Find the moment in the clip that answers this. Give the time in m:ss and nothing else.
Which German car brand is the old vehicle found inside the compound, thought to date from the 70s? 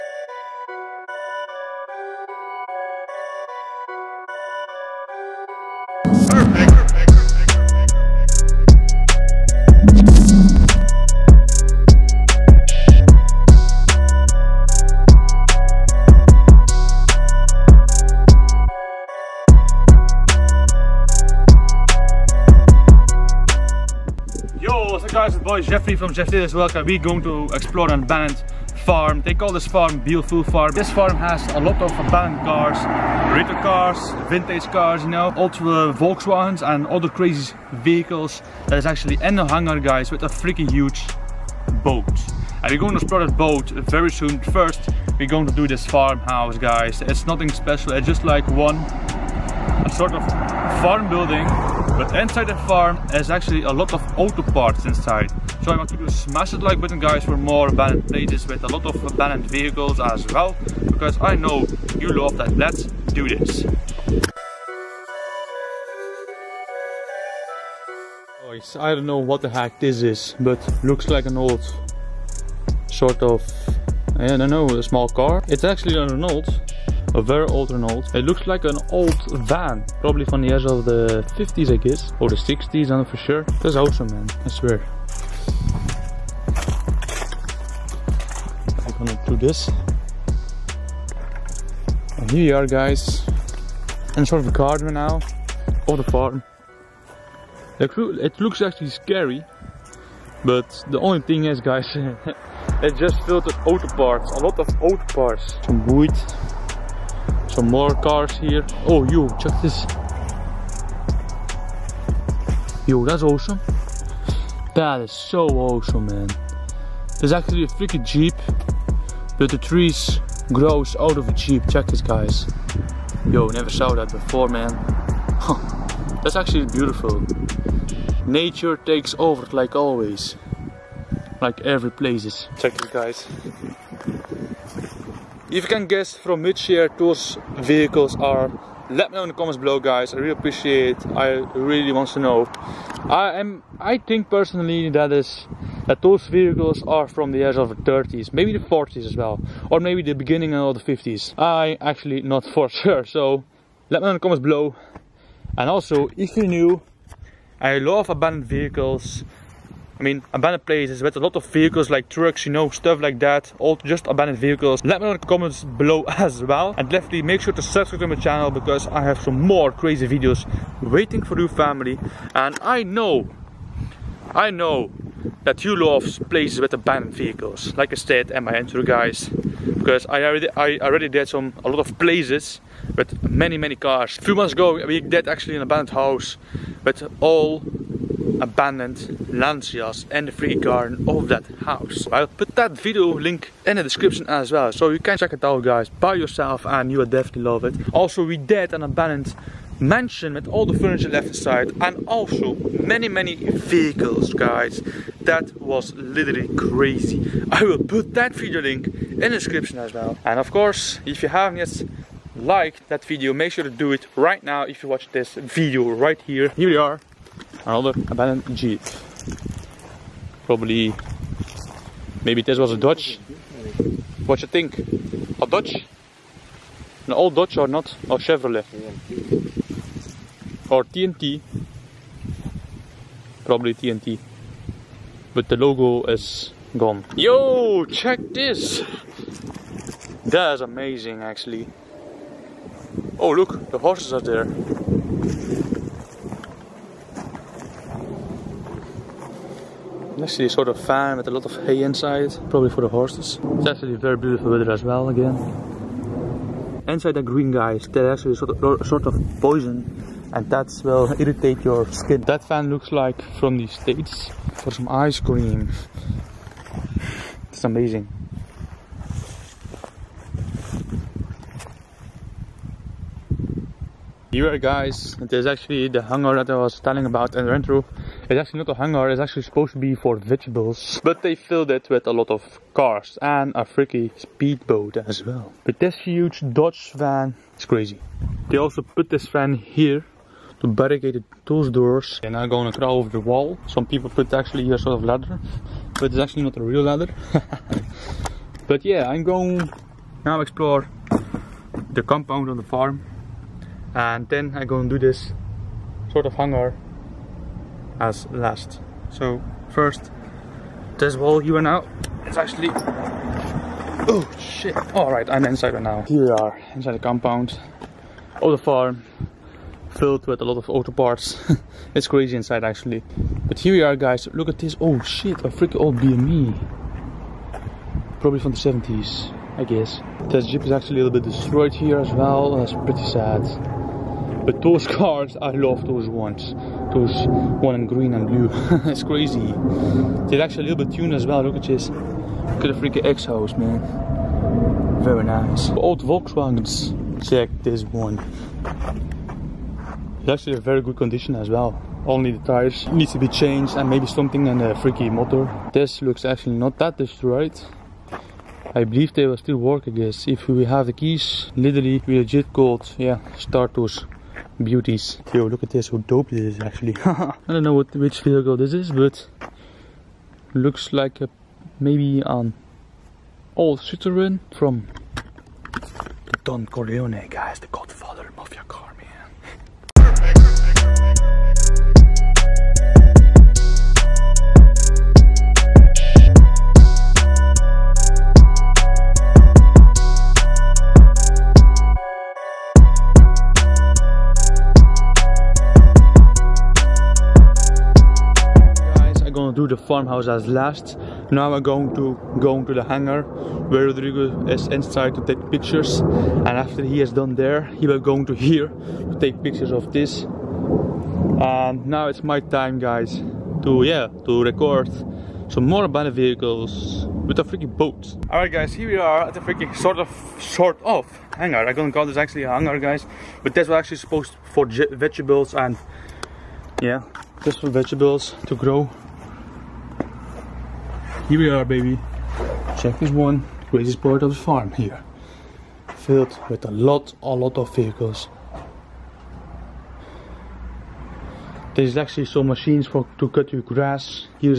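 5:25.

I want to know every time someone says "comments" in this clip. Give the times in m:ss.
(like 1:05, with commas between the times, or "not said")
2:19, 2:34, 2:45.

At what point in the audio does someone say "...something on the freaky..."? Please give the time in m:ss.
5:54.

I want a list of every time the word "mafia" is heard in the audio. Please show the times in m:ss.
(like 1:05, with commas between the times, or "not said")
6:18.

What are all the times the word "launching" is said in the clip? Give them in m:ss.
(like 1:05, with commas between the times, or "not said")
not said.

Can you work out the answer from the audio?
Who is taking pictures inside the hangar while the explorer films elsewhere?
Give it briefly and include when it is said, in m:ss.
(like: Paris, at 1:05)
Rodrigo, at 6:43.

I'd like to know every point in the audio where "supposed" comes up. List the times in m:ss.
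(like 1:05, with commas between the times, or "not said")
4:39, 7:03.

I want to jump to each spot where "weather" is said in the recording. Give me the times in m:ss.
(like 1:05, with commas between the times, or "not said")
4:14.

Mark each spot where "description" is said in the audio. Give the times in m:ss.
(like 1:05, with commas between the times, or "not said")
3:13, 3:29.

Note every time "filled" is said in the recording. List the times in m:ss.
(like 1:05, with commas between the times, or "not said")
4:41, 5:19, 7:15.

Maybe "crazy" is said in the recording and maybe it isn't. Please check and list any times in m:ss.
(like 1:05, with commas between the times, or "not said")
0:37, 2:49, 3:26, 4:47, 5:22, 5:39.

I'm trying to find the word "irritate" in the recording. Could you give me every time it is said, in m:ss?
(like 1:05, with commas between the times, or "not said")
4:21.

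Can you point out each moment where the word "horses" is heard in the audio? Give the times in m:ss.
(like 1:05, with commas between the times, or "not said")
4:03, 4:12.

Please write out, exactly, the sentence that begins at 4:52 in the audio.
They're now going to crawl over the wall.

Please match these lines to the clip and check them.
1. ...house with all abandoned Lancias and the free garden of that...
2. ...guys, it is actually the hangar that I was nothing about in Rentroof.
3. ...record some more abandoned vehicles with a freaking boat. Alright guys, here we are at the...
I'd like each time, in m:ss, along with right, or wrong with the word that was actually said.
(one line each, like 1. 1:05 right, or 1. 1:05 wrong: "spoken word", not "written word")
1. 3:05 right
2. 4:34 wrong: "telling", not "nothing"
3. 6:54 right.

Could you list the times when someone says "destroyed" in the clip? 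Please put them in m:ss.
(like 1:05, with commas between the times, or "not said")
5:31, 5:56.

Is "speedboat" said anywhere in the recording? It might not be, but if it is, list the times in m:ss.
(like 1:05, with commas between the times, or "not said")
4:44.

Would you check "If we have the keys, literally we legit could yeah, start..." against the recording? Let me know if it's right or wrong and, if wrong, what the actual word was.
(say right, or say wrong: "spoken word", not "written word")
right.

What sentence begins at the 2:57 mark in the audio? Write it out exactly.
Like I said am my intro guys.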